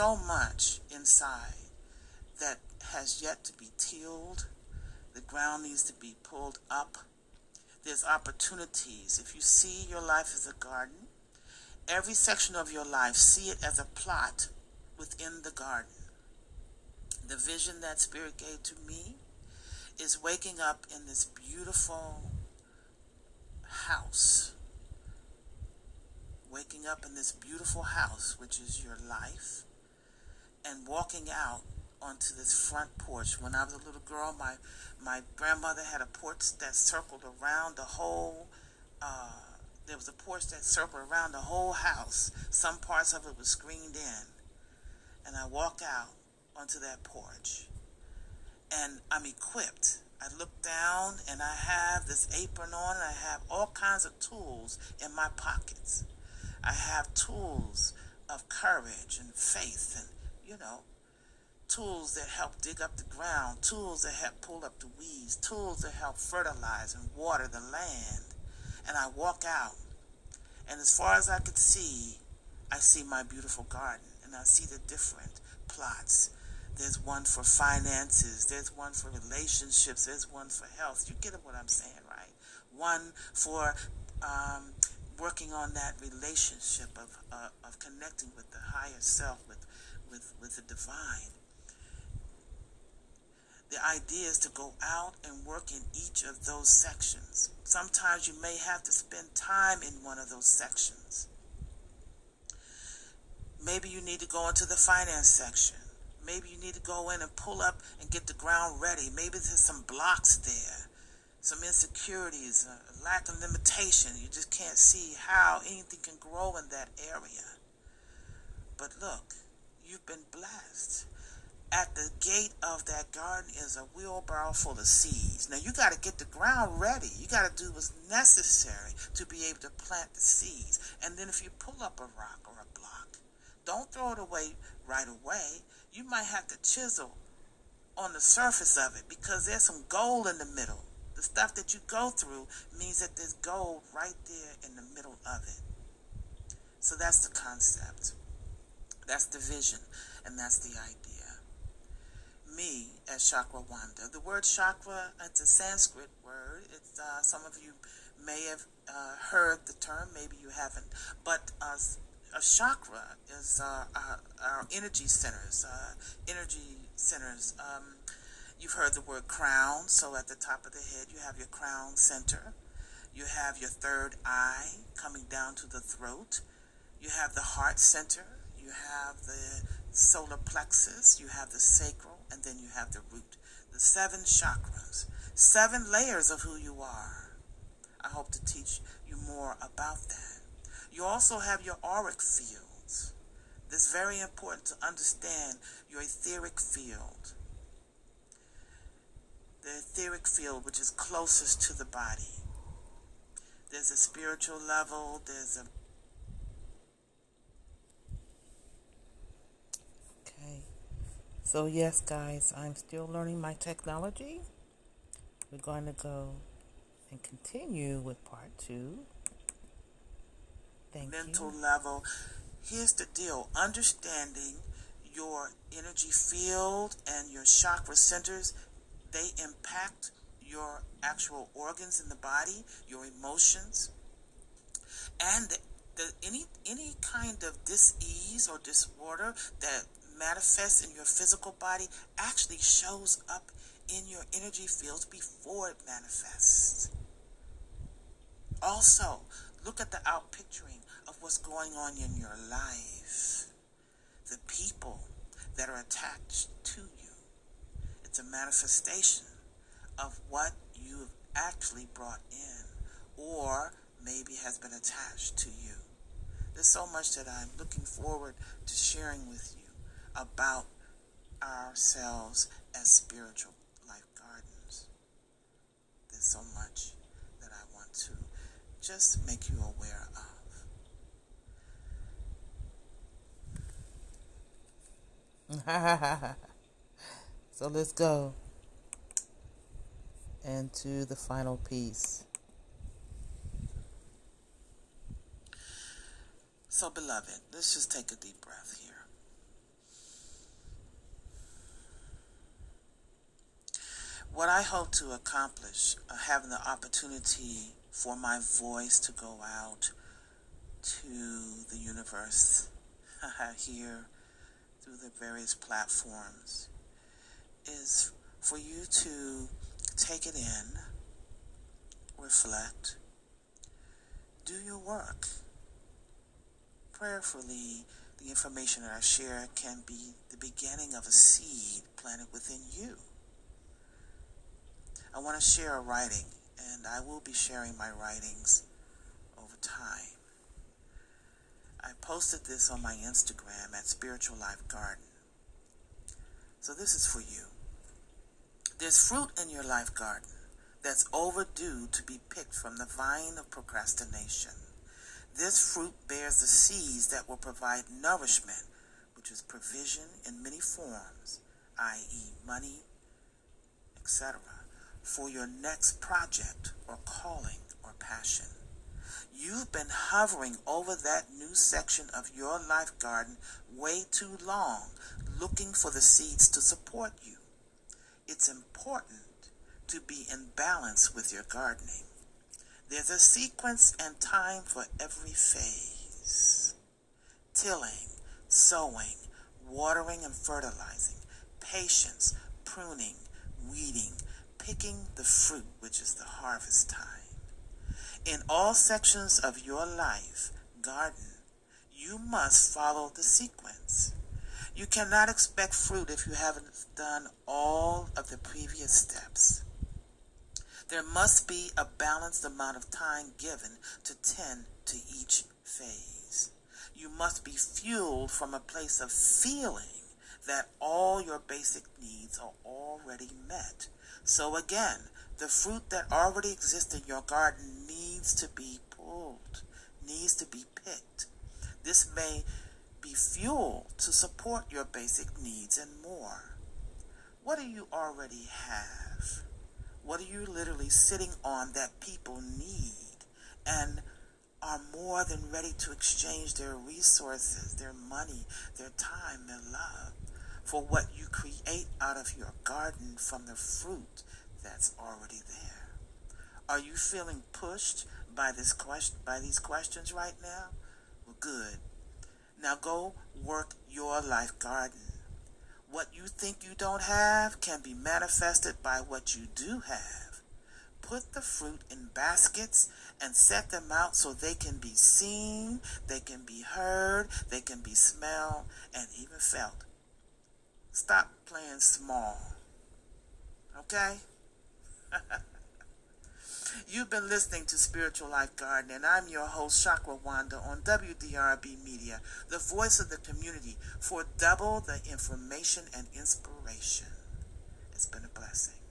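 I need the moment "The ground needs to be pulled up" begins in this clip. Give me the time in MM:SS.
00:05.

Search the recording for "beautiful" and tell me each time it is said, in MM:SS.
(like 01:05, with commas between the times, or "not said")
00:21, 00:27, 01:13.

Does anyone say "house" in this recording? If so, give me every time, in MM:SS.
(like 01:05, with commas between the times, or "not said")
00:23, 00:27, 00:41.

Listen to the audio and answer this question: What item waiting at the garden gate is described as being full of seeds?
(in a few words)
wheelbarrow.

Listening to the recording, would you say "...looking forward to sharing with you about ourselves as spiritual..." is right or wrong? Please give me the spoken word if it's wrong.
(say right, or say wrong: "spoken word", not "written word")
right.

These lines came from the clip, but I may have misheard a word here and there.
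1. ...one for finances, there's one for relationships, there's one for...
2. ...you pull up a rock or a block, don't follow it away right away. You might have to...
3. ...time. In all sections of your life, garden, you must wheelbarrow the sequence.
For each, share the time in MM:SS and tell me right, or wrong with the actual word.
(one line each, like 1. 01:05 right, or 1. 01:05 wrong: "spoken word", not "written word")
1. 01:16 right
2. 02:11 wrong: "throw", not "follow"
3. 06:36 wrong: "follow", not "wheelbarrow".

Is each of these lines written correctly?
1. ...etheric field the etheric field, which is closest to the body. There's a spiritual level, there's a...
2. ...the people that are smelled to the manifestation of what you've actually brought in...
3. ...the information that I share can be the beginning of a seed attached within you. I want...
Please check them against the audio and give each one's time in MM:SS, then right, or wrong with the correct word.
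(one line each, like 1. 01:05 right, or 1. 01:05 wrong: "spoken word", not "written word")
1. 03:16 right
2. 04:14 wrong: "attached", not "smelled"
3. 05:28 wrong: "planted", not "attached".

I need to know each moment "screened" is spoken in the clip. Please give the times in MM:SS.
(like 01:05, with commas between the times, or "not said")
00:43.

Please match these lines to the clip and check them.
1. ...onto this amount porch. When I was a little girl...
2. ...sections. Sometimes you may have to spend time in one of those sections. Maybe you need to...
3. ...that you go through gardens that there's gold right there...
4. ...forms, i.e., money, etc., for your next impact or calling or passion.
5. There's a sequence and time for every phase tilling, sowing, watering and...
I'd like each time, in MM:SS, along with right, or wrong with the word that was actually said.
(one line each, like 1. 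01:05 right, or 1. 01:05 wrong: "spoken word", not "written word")
1. 00:31 wrong: "front", not "amount"
2. 01:36 right
3. 02:21 wrong: "means", not "gardens"
4. 06:00 wrong: "project", not "impact"
5. 06:22 right.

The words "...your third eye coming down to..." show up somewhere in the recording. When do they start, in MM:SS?
02:53.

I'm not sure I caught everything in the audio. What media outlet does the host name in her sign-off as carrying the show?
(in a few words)
WDRB Media.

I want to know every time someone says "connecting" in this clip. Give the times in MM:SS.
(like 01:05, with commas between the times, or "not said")
01:27.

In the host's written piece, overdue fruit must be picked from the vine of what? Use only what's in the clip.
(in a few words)
procrastination.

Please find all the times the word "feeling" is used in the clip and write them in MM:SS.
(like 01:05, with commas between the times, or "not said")
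06:59, 07:36.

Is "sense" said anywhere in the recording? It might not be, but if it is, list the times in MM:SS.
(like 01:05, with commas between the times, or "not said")
not said.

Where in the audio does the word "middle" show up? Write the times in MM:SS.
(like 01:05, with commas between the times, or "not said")
02:20, 02:24.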